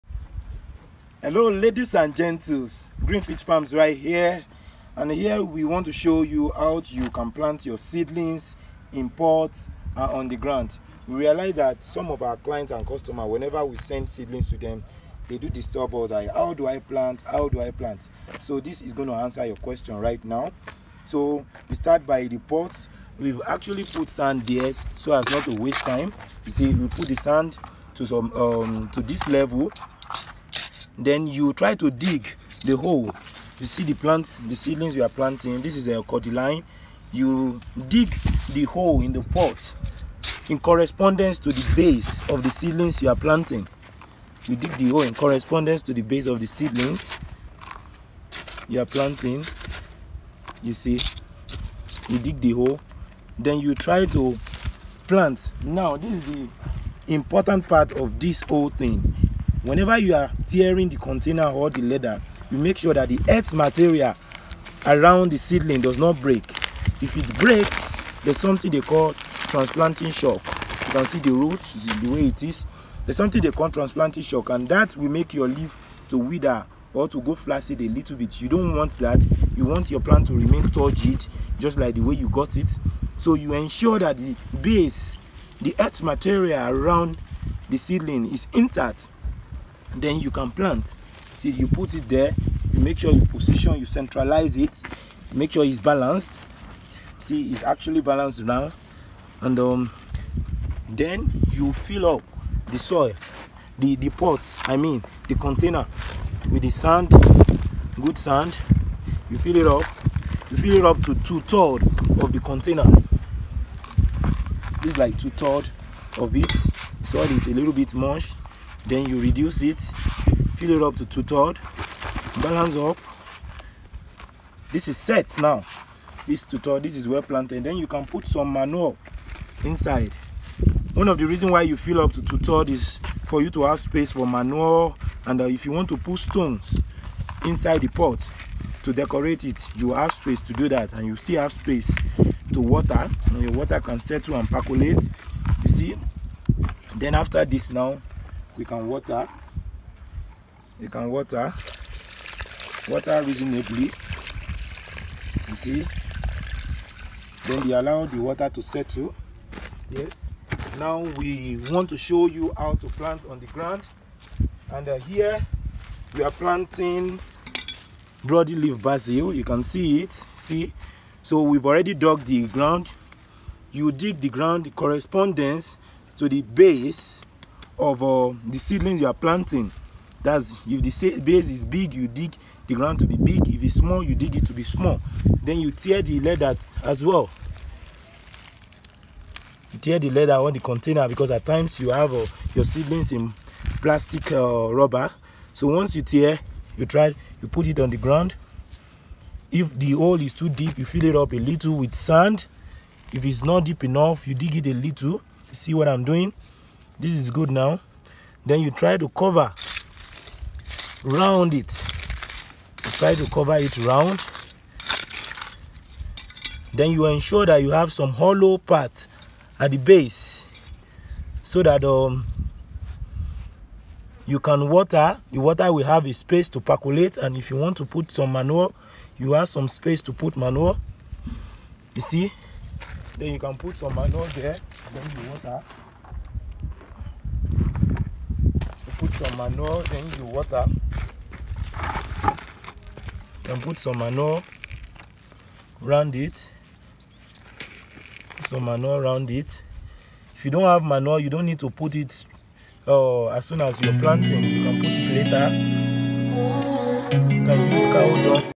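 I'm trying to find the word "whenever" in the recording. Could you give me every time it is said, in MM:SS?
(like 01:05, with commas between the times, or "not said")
00:13, 00:59.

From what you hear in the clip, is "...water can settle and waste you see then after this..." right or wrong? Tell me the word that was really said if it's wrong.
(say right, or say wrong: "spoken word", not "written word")
wrong: "percolate", not "waste".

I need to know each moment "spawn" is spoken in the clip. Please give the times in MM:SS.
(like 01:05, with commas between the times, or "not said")
not said.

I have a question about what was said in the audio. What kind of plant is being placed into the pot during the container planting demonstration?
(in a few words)
Cordyline.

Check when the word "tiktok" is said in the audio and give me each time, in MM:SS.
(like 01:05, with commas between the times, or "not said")
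not said.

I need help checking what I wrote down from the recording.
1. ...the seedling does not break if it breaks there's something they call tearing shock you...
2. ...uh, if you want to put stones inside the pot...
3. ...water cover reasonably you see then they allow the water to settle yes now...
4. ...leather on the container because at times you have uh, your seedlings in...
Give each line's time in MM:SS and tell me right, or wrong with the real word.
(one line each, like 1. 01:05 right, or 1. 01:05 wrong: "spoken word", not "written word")
1. 01:05 wrong: "transplanting", not "tearing"
2. 02:15 right
3. 02:31 wrong: "water", not "cover"
4. 03:10 right.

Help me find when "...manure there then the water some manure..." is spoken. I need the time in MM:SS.
03:53.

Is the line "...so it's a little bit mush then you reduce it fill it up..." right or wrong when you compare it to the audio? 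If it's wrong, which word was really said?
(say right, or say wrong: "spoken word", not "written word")
right.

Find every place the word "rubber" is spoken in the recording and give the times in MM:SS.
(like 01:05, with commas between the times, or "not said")
03:14.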